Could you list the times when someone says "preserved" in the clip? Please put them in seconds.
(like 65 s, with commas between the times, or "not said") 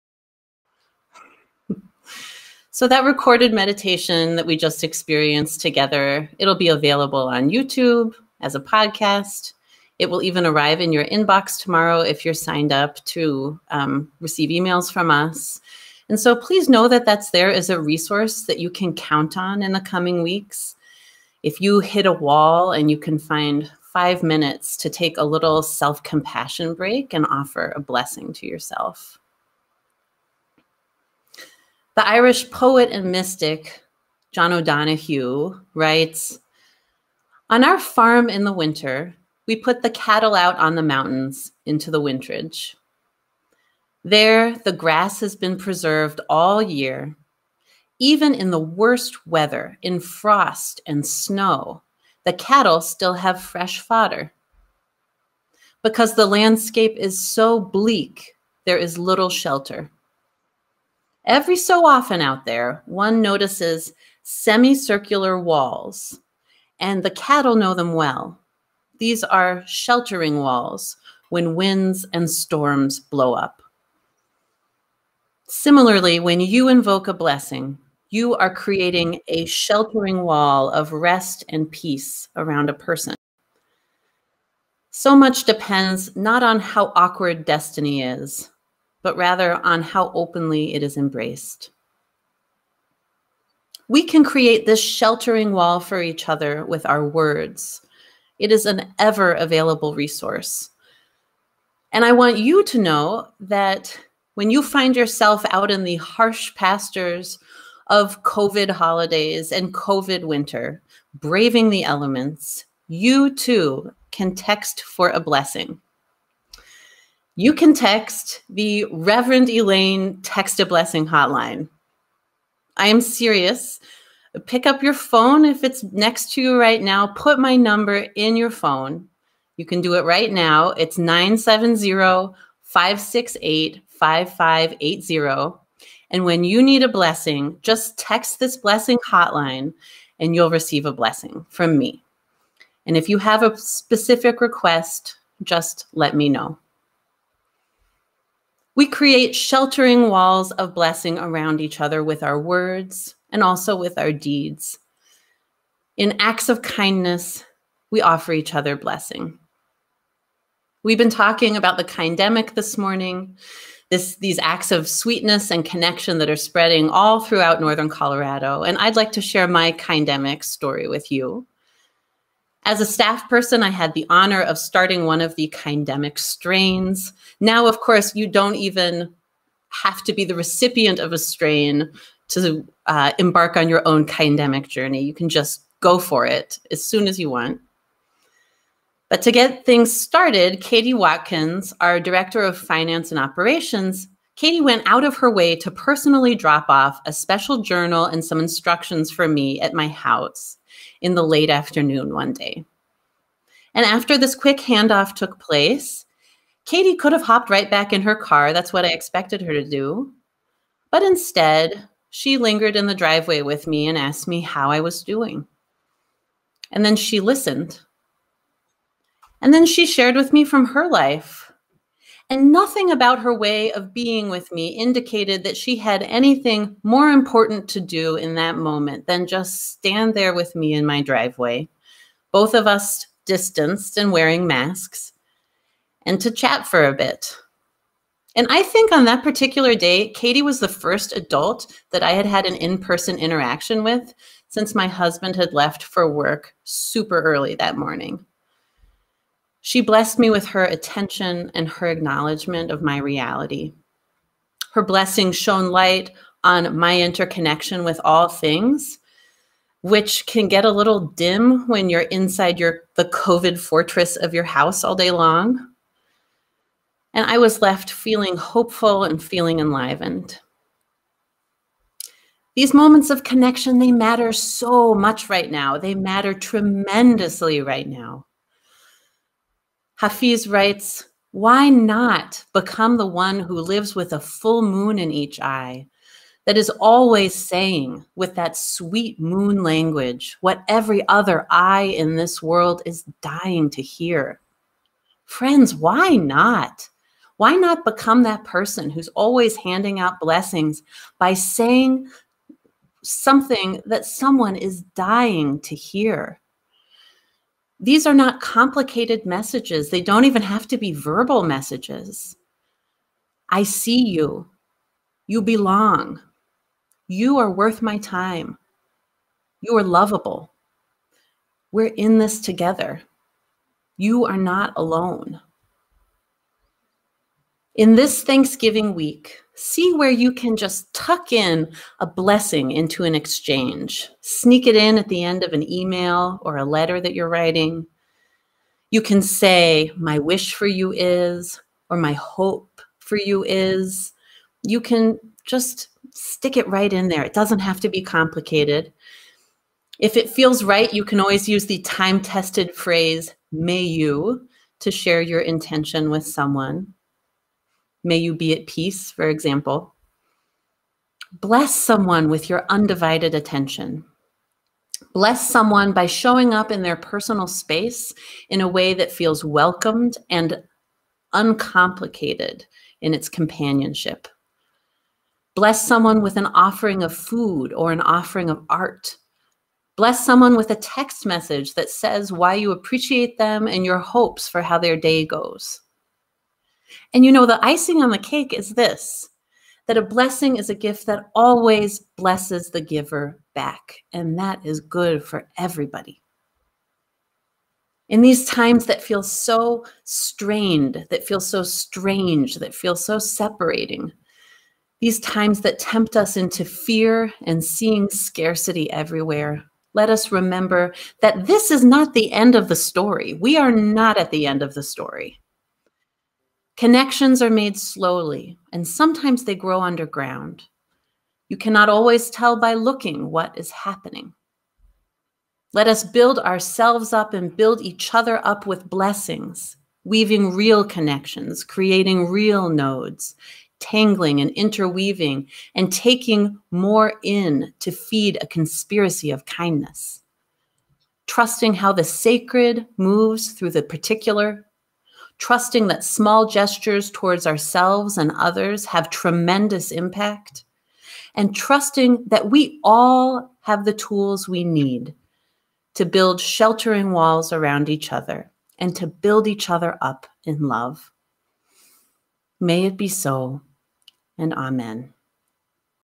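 45 s.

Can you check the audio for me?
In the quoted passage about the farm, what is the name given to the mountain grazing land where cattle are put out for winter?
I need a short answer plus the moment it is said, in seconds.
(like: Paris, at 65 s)
winterage, at 41 s.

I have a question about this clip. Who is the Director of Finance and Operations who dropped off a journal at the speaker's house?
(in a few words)
Katie Watkins.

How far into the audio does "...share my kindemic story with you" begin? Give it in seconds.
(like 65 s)
169 s.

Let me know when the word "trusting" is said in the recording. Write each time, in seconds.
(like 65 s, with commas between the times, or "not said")
441 s, 445 s, 451 s.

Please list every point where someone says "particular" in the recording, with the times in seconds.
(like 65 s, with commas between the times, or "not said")
239 s, 443 s.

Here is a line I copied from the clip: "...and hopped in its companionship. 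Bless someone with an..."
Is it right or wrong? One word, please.
wrong.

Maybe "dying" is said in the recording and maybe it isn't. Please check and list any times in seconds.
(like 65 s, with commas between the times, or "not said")
293 s, 304 s.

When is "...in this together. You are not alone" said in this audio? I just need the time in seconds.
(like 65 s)
321 s.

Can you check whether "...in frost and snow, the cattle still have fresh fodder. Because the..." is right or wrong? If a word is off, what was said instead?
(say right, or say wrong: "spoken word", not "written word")
right.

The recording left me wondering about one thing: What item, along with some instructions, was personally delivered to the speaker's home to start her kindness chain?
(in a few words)
A special journal.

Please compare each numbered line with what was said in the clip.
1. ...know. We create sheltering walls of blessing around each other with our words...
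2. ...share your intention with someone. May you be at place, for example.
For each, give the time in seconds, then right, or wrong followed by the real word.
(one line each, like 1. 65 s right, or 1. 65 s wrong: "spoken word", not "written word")
1. 146 s right
2. 354 s wrong: "peace", not "place".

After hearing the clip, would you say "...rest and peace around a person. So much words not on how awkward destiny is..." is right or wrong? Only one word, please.
wrong.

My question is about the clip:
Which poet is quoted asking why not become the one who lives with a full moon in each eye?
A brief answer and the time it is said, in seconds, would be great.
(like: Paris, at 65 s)
Hafiz, at 280 s.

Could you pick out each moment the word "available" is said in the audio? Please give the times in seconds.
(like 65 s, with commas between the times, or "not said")
6 s, 99 s.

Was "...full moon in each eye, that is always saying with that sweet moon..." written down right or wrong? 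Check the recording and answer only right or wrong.
right.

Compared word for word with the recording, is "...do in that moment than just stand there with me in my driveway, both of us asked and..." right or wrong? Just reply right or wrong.
wrong.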